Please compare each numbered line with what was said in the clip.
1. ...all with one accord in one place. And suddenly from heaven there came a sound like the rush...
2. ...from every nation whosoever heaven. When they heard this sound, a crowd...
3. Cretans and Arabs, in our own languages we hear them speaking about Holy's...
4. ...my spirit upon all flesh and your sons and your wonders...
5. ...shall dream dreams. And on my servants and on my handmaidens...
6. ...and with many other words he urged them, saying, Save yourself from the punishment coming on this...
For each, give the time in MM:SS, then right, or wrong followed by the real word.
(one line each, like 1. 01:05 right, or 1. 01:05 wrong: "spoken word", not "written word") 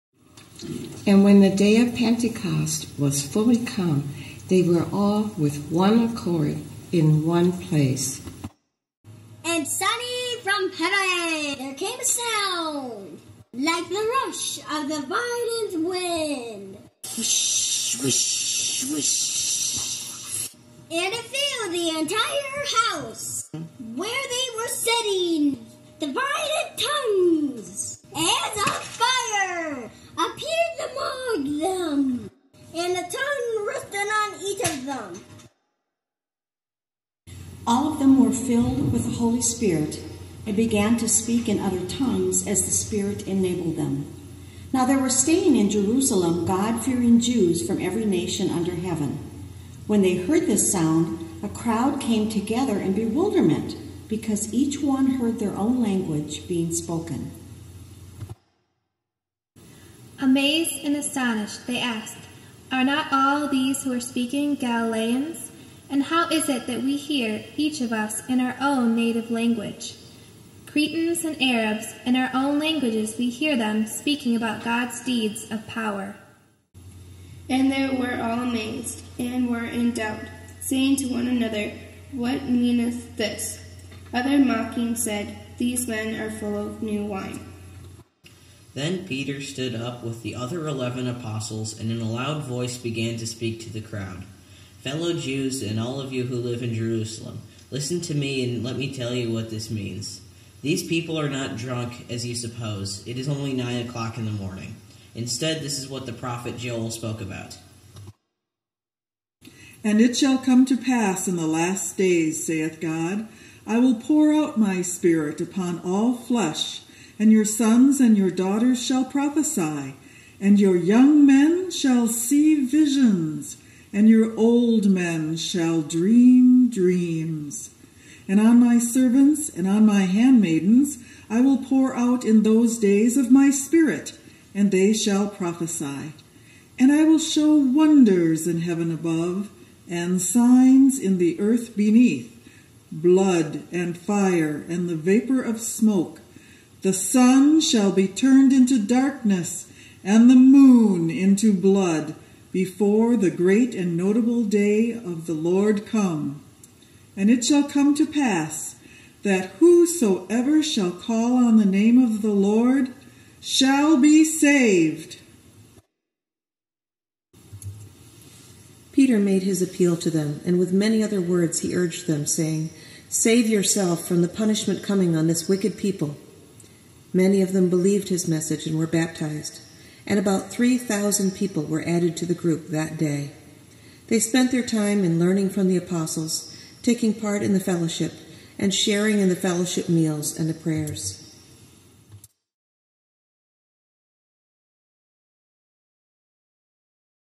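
1. 00:04 right
2. 00:47 wrong: "under", not "whosoever"
3. 01:10 wrong: "God", not "Holy"
4. 01:54 wrong: "daughters", not "wonders"
5. 02:05 right
6. 02:50 right.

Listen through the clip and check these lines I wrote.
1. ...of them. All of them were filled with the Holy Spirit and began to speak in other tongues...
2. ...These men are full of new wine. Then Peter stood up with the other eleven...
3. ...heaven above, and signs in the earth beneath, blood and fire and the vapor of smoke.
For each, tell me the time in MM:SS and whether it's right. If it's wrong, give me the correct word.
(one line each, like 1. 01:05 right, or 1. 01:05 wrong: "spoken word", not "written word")
1. 00:34 right
2. 01:25 right
3. 02:18 right.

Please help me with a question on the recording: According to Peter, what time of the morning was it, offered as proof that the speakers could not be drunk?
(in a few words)
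9 o'clock.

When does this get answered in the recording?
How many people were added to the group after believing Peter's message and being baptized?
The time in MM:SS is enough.
03:00.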